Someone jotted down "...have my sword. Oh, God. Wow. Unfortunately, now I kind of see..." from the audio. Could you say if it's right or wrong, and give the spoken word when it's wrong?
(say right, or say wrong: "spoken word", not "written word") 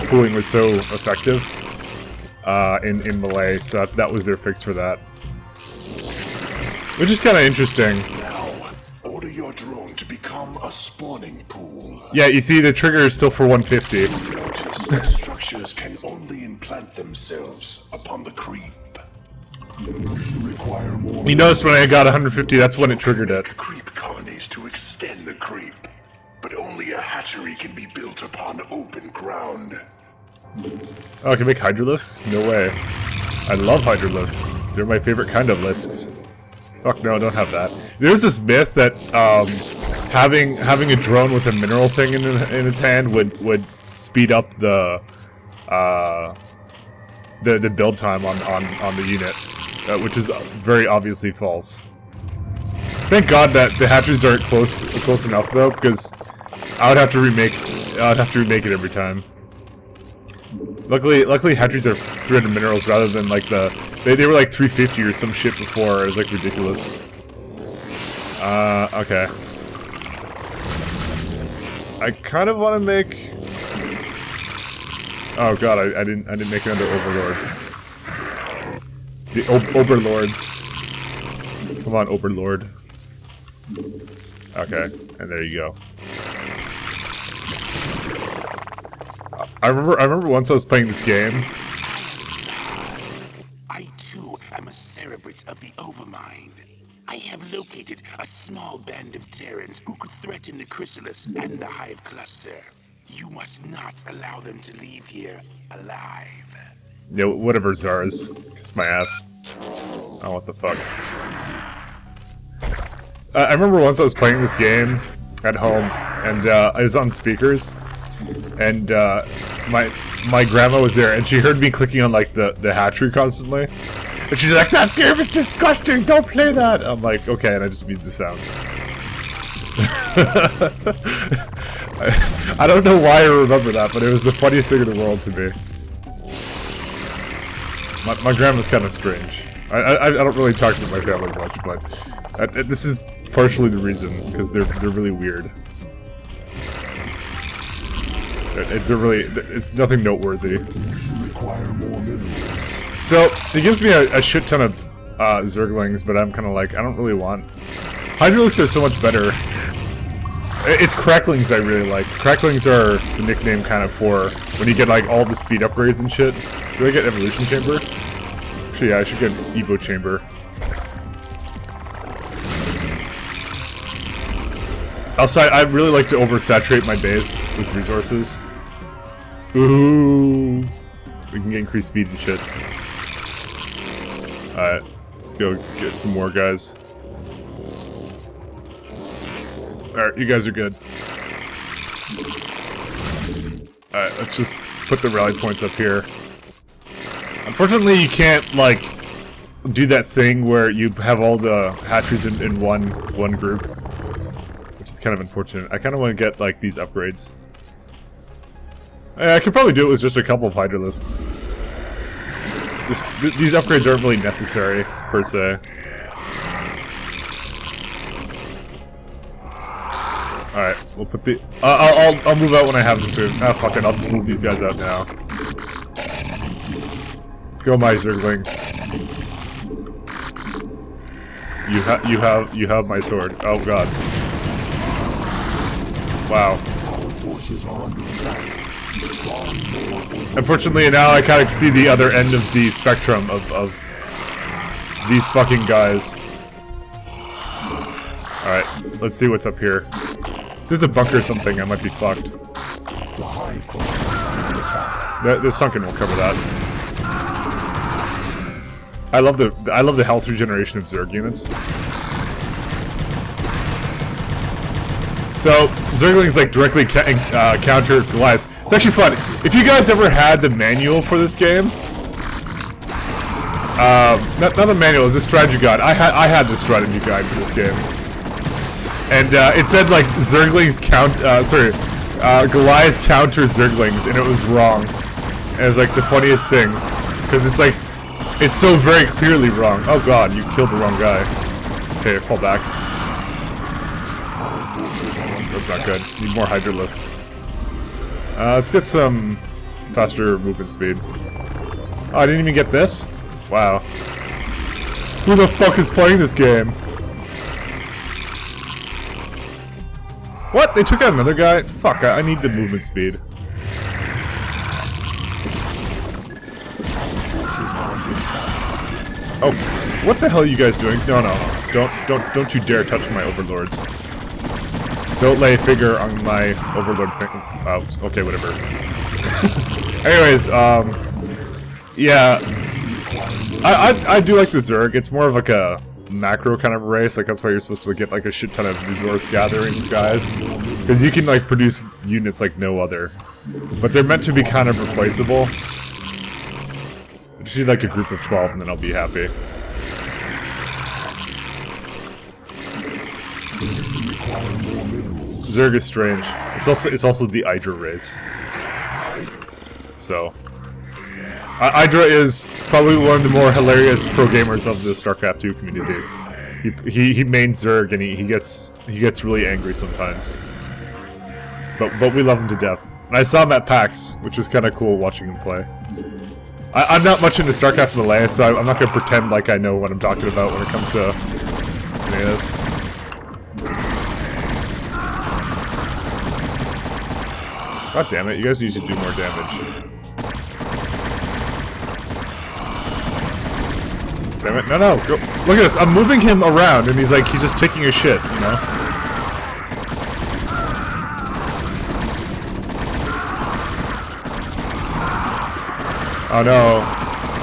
right.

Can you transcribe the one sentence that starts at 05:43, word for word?
But they're meant to be kind of replaceable.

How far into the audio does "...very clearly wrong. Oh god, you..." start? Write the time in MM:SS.
04:48.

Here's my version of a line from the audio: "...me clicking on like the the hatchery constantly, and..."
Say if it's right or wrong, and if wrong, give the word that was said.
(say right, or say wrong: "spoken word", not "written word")
right.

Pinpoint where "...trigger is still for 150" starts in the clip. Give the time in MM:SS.
00:12.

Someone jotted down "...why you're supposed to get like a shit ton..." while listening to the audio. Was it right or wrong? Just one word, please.
right.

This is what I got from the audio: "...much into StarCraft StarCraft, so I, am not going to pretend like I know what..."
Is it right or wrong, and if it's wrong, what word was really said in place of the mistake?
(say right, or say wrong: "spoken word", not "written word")
wrong: "Melee", not "StarCraft".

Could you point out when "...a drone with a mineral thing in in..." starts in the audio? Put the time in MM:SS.
00:40.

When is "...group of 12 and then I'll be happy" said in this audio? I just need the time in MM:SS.
05:47.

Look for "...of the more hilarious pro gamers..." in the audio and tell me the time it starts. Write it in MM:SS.
06:03.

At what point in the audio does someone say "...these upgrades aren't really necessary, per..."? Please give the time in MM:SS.
03:33.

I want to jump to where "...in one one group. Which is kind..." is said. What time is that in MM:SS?
03:22.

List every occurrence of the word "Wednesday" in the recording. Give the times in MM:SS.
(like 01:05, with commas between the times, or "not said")
not said.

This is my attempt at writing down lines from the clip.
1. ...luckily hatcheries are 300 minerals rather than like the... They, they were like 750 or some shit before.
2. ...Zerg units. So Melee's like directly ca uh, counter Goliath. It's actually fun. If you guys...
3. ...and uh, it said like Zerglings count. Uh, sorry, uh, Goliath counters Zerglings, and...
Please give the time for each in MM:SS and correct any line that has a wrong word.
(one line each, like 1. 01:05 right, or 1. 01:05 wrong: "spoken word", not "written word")
1. 01:01 wrong: "350", not "750"
2. 04:20 wrong: "Zergling", not "Melee"
3. 04:39 right.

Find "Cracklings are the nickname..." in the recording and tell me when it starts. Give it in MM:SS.
02:42.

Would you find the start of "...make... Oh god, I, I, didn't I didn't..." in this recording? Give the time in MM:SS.
01:12.